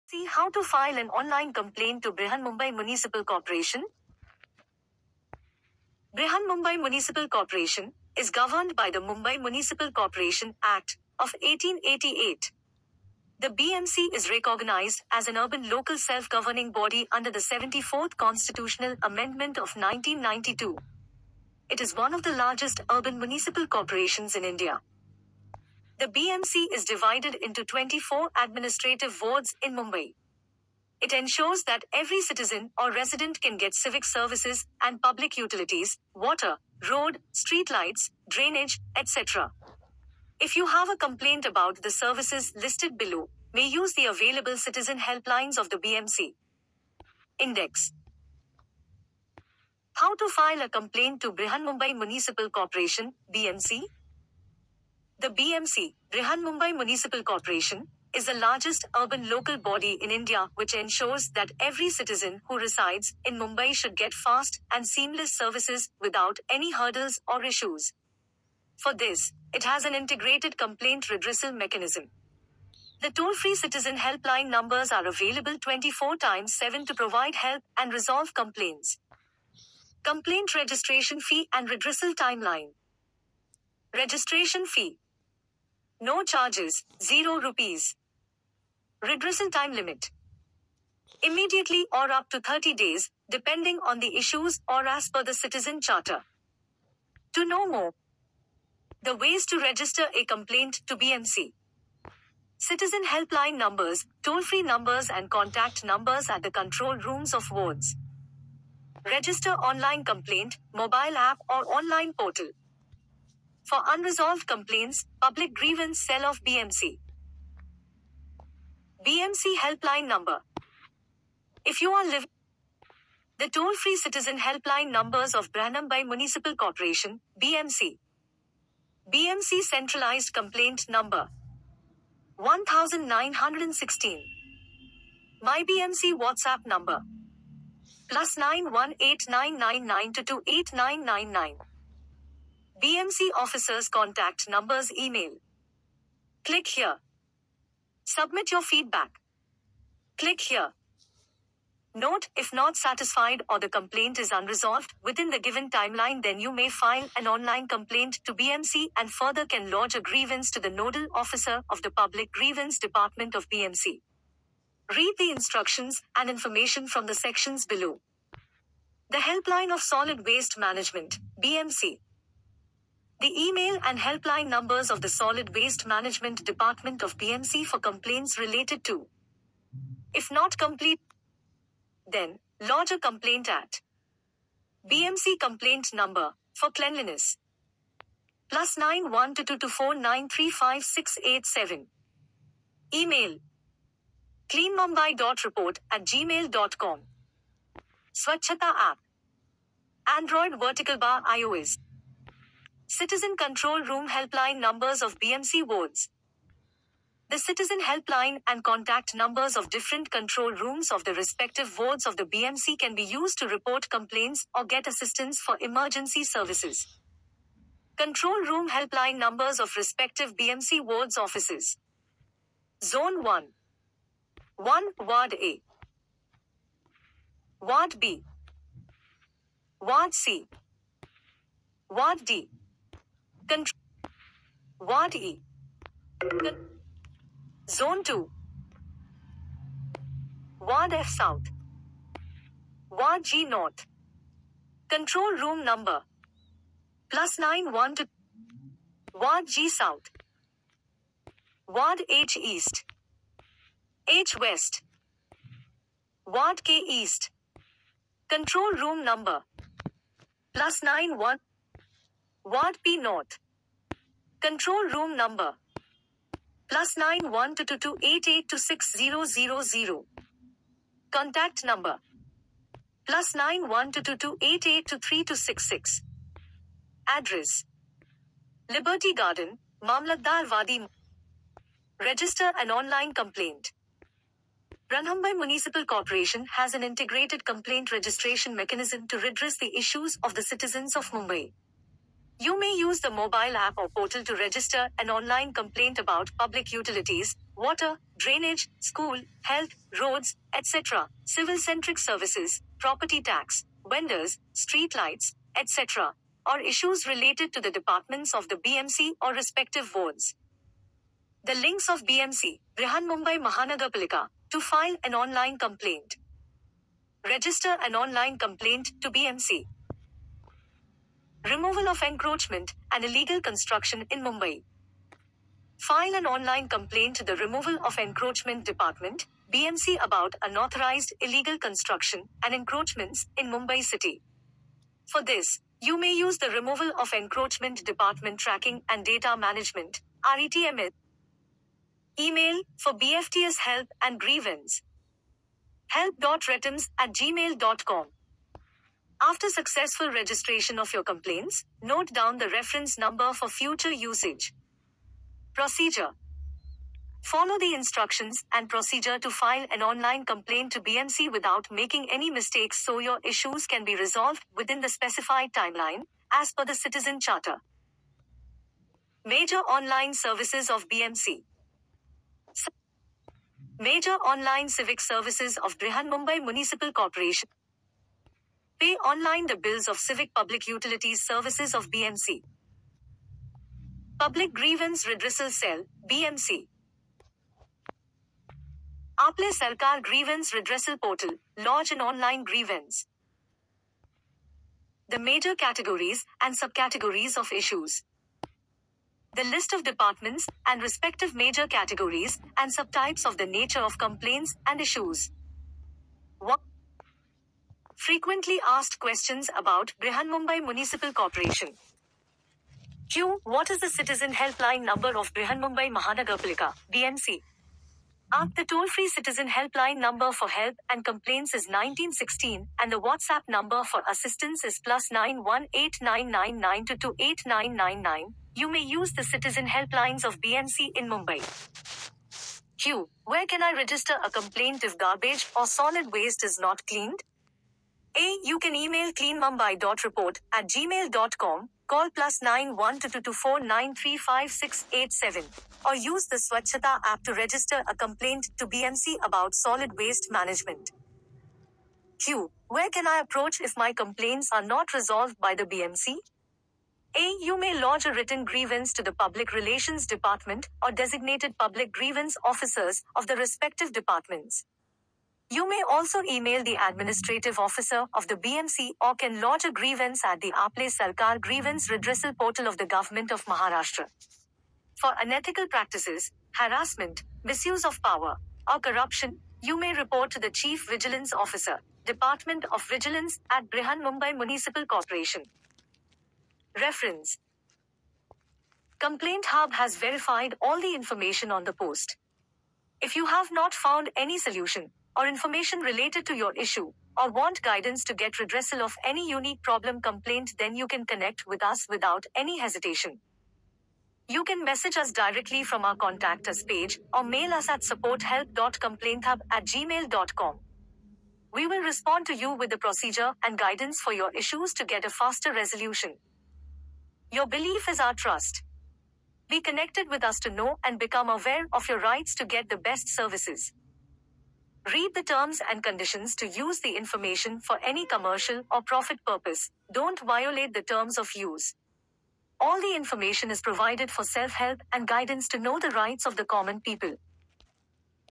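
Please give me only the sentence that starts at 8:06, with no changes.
Reference Complaint Hub has verified all the information on the post.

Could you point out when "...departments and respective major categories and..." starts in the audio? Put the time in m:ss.
6:39.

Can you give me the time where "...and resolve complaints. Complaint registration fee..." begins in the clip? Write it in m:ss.
1:17.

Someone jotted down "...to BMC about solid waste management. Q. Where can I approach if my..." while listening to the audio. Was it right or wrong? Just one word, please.
right.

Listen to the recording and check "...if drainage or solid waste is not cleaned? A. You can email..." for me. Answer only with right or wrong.
wrong.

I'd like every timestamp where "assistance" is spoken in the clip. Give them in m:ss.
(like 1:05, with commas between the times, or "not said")
3:34, 7:04.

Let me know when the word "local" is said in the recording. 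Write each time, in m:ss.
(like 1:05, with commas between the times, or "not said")
0:15, 0:59.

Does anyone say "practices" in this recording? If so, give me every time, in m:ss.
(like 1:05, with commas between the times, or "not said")
7:55.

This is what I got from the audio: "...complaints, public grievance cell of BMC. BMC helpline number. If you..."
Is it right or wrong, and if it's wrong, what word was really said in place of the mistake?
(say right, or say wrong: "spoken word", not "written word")
right.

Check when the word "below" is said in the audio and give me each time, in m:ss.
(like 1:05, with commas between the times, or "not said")
0:42, 2:47.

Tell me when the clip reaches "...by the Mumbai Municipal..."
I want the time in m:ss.
0:08.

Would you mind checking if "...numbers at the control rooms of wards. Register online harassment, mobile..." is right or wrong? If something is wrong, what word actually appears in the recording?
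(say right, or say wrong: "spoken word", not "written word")
wrong: "complaint", not "harassment".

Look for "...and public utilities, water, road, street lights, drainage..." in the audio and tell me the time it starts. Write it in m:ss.
0:34.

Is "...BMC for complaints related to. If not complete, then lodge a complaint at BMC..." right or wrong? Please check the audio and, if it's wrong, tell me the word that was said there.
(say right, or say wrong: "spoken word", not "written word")
right.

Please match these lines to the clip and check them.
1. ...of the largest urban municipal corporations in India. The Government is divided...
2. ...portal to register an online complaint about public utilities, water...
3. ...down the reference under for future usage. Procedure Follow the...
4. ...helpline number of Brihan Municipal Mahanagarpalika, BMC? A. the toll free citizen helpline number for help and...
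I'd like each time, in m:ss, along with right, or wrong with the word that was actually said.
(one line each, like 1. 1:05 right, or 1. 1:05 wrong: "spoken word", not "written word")
1. 0:22 wrong: "BMC", not "Government"
2. 4:53 right
3. 5:52 wrong: "number", not "under"
4. 6:54 wrong: "Mumbai", not "Municipal".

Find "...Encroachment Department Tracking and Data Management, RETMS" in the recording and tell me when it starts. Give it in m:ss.
5:37.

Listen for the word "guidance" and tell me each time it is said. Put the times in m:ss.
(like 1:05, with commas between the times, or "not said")
8:17, 8:33, 8:55.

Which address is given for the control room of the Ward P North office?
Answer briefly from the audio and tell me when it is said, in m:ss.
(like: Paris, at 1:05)
Liberty Garden, Mamlatdar Wadi, at 4:38.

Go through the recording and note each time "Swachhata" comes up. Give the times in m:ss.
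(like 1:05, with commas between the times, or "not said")
3:18, 7:26.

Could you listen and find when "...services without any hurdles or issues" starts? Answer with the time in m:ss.
1:05.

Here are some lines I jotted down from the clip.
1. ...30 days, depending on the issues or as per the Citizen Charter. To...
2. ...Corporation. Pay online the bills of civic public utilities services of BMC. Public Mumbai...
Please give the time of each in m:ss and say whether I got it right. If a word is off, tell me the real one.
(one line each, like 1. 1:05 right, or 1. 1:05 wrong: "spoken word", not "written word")
1. 1:32 right
2. 6:16 wrong: "Grievance", not "Mumbai".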